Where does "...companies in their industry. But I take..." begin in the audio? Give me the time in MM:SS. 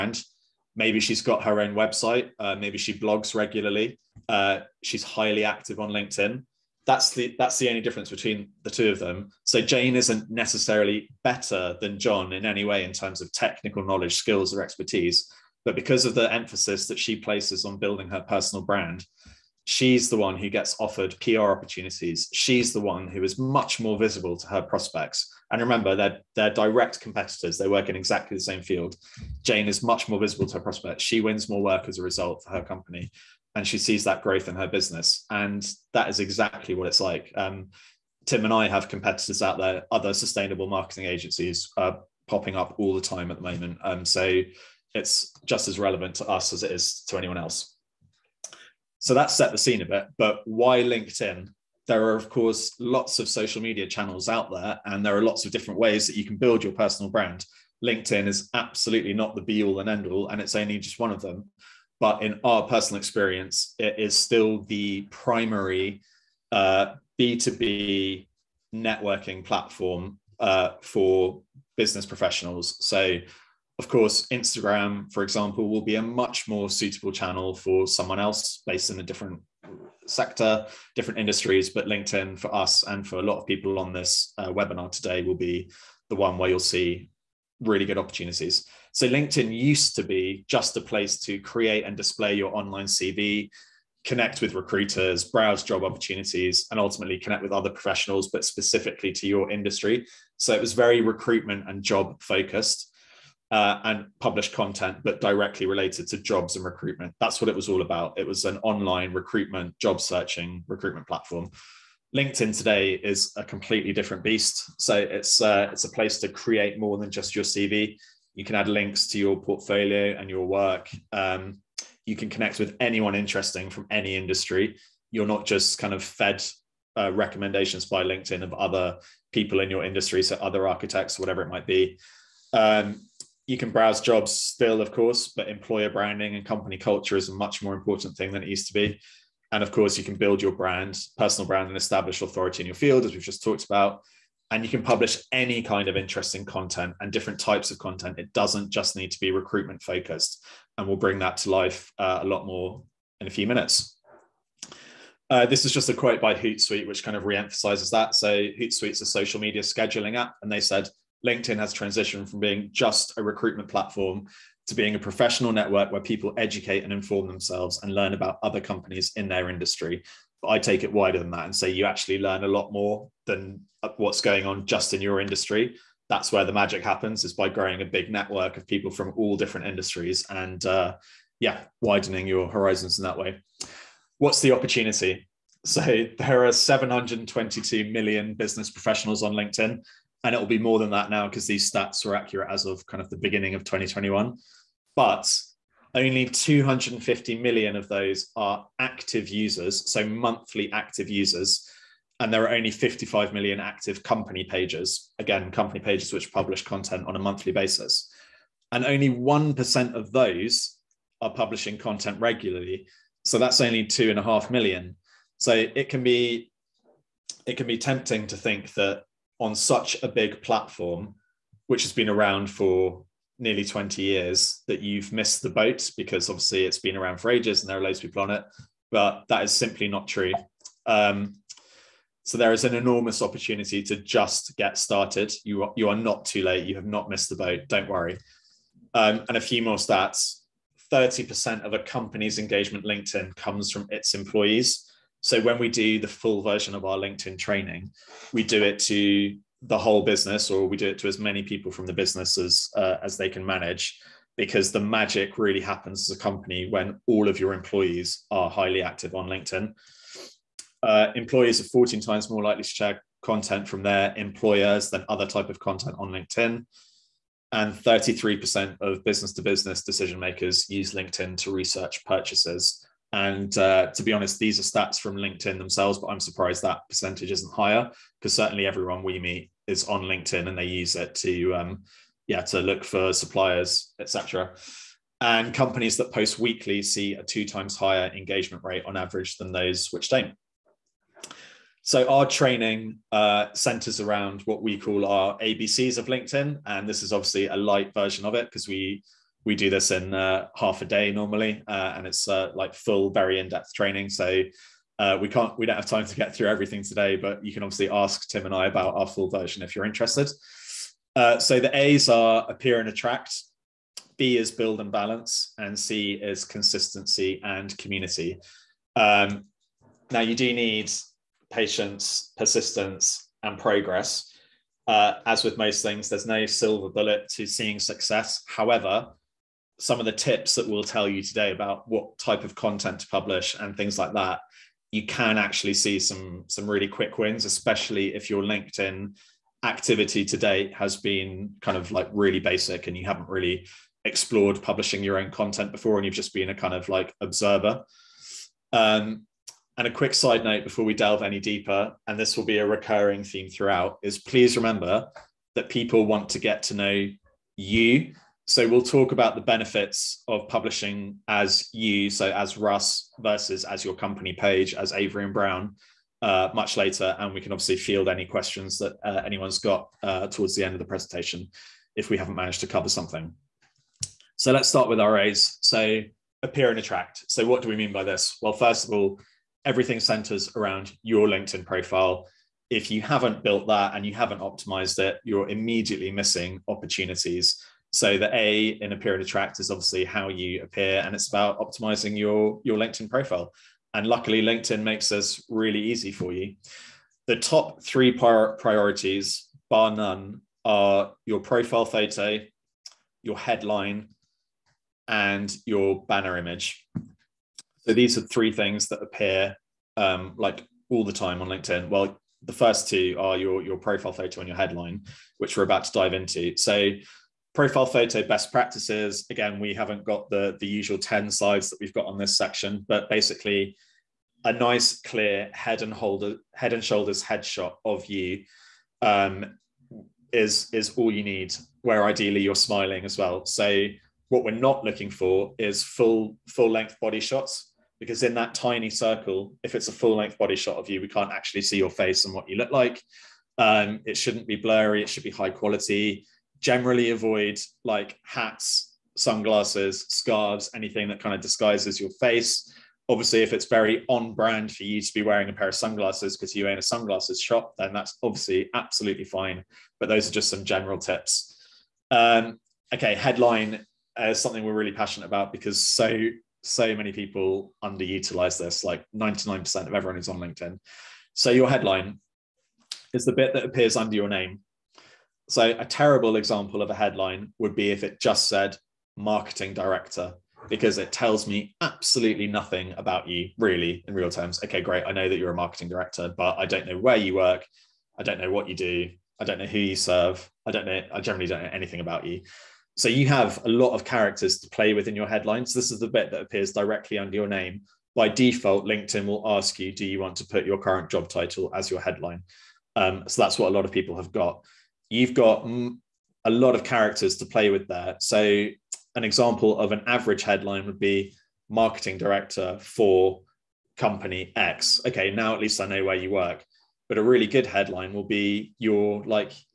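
02:48.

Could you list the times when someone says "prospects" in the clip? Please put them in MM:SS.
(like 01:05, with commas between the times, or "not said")
00:24, 00:30.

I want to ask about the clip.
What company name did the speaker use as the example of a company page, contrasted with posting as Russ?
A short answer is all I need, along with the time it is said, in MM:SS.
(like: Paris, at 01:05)
Avery and Brown, at 06:04.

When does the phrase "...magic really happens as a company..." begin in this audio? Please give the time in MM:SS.
04:14.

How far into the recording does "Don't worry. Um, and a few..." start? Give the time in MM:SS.
03:57.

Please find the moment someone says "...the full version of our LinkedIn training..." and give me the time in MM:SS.
04:05.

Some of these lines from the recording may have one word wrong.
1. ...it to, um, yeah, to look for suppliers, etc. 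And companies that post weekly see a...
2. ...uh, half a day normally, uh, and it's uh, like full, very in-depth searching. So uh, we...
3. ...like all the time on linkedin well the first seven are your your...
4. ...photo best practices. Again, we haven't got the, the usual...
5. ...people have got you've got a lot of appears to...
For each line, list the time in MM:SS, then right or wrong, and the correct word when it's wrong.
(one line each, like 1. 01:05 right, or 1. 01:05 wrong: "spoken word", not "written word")
1. 04:40 right
2. 05:00 wrong: "training", not "searching"
3. 06:50 wrong: "two", not "seven"
4. 06:57 right
5. 08:23 wrong: "characters", not "appears".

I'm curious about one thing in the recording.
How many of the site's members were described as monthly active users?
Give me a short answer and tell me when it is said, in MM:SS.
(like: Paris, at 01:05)
250 million, at 03:16.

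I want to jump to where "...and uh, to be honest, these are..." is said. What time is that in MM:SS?
04:33.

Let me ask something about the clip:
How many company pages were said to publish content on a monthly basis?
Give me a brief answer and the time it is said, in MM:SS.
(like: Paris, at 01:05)
55 million, at 03:22.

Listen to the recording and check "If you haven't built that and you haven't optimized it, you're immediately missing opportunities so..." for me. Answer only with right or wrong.
right.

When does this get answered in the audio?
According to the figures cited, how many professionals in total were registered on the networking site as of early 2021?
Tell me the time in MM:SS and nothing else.
03:06.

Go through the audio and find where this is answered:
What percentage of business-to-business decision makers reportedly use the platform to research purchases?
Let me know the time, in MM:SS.
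04:27.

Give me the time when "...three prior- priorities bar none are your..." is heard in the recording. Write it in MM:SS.
06:37.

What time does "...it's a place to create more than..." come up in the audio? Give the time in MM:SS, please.
01:55.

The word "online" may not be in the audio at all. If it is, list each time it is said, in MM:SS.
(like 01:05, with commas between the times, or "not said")
01:32, 01:48.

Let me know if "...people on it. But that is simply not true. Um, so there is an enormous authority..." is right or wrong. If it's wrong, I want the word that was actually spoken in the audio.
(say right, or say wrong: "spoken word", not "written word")
wrong: "opportunity", not "authority".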